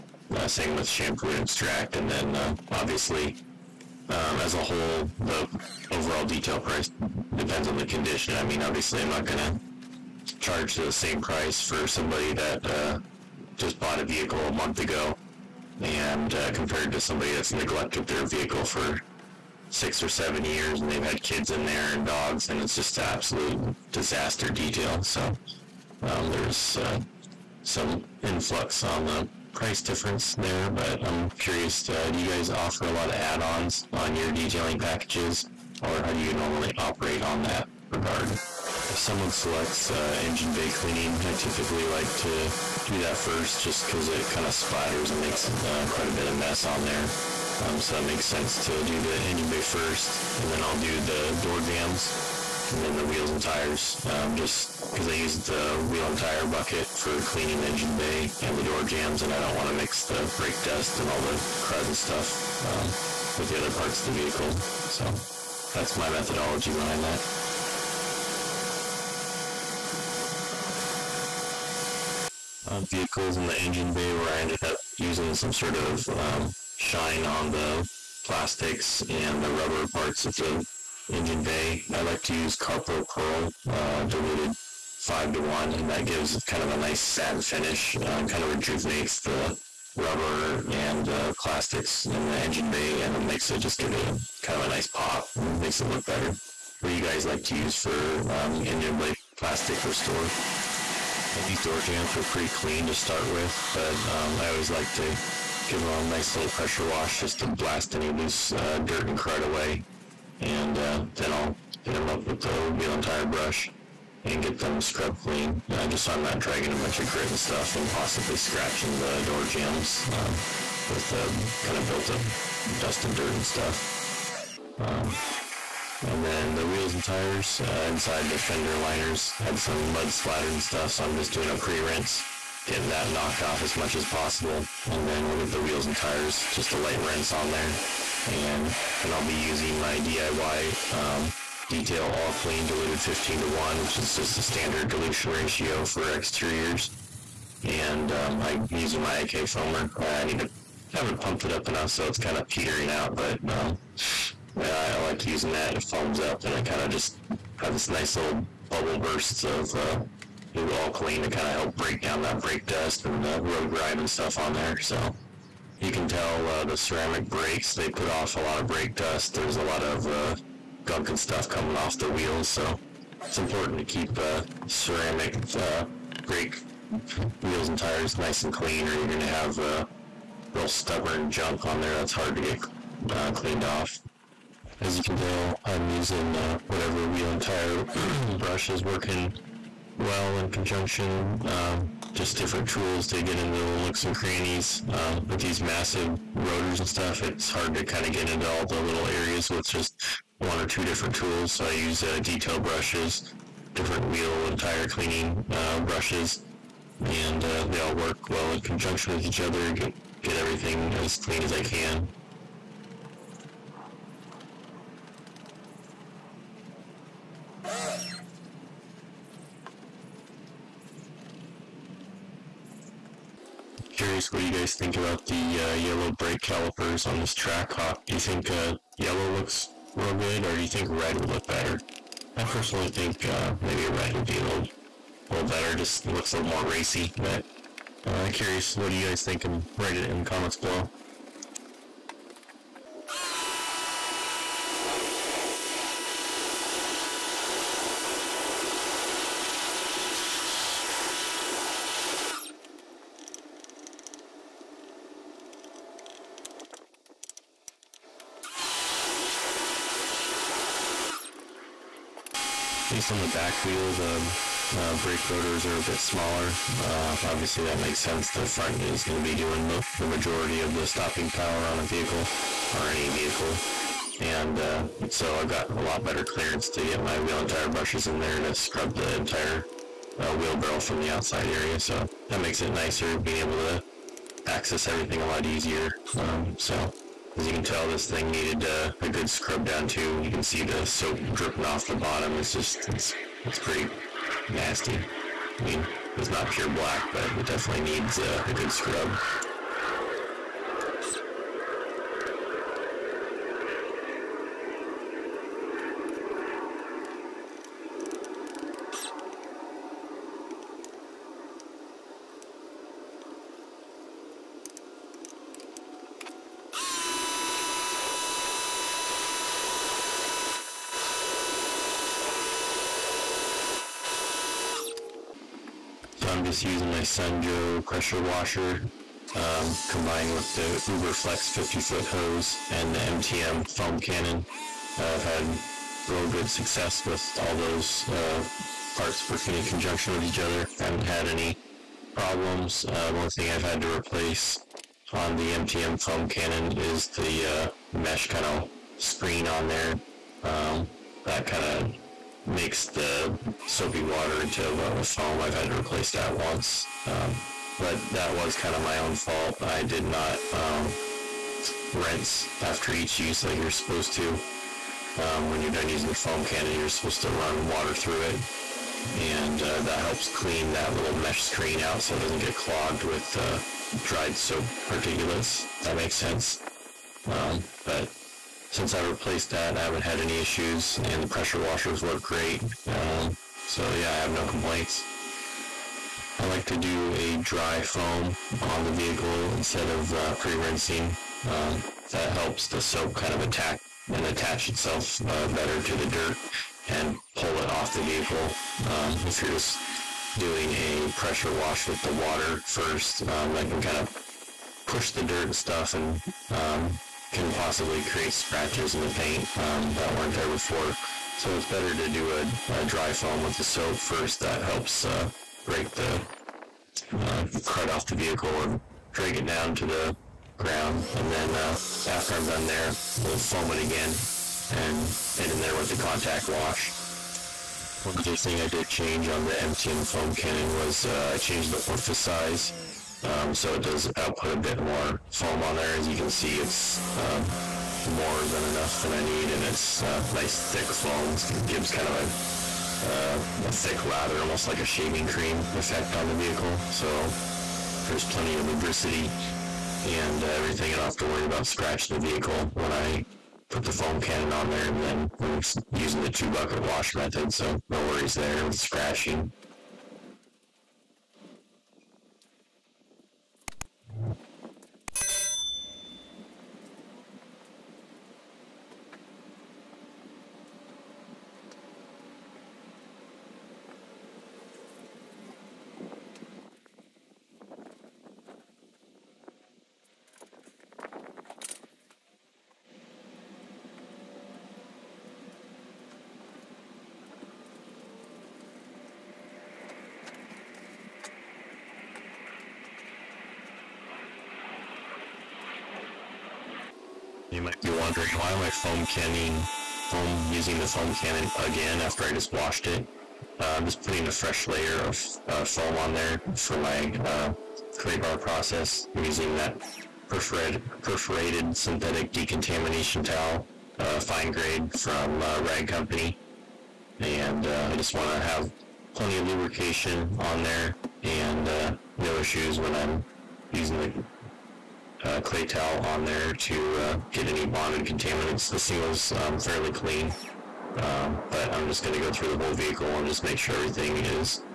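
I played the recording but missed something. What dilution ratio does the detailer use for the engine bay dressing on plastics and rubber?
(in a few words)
5 to 1.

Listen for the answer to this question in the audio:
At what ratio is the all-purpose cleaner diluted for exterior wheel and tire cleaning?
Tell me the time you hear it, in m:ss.
2:22.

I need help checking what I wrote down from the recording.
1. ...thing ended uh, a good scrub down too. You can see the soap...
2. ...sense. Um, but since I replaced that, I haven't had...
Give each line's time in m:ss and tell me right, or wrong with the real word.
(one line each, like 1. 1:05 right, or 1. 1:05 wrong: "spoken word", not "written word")
1. 4:48 wrong: "needed", not "ended"
2. 6:16 right.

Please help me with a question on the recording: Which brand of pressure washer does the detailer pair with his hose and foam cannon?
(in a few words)
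Sun Joe.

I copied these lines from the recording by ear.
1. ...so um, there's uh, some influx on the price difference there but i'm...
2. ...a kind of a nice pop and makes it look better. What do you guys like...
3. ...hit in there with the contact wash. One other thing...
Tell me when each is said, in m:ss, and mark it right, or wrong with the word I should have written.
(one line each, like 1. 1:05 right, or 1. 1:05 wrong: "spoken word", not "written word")
1. 0:25 right
2. 1:34 right
3. 7:05 right.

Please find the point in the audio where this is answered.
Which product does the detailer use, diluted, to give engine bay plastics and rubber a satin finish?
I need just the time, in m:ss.
1:22.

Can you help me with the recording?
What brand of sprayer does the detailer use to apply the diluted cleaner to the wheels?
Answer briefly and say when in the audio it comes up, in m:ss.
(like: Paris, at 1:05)
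AK foamer, at 2:29.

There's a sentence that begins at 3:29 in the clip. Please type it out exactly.
Get get everything as clean as I can.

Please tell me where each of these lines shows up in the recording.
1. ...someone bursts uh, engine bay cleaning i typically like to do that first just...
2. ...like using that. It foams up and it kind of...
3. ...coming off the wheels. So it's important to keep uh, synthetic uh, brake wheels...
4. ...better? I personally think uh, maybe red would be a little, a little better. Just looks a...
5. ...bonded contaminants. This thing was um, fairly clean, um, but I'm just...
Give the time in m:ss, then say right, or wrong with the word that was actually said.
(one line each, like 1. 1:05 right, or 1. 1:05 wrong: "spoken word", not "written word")
1. 0:38 wrong: "selects", not "bursts"
2. 2:34 right
3. 2:51 wrong: "ceramic", not "synthetic"
4. 3:51 right
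5. 8:47 right.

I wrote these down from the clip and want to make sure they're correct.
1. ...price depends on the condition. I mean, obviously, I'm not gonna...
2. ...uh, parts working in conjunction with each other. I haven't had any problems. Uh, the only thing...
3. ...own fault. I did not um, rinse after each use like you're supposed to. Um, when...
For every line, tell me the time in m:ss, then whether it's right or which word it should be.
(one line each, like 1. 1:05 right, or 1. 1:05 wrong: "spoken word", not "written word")
1. 0:06 right
2. 5:38 right
3. 5:58 right.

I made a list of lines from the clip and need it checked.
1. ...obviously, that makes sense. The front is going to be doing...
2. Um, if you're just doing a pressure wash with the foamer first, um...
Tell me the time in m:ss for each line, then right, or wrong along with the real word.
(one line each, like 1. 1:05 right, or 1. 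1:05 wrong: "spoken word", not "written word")
1. 4:27 right
2. 6:38 wrong: "water", not "foamer".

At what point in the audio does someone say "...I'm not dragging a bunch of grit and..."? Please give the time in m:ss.
1:56.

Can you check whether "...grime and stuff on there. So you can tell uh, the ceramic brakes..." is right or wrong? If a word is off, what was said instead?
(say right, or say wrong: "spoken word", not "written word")
right.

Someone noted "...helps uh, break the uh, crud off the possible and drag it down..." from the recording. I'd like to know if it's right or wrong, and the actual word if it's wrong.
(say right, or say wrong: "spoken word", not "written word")
wrong: "vehicle", not "possible".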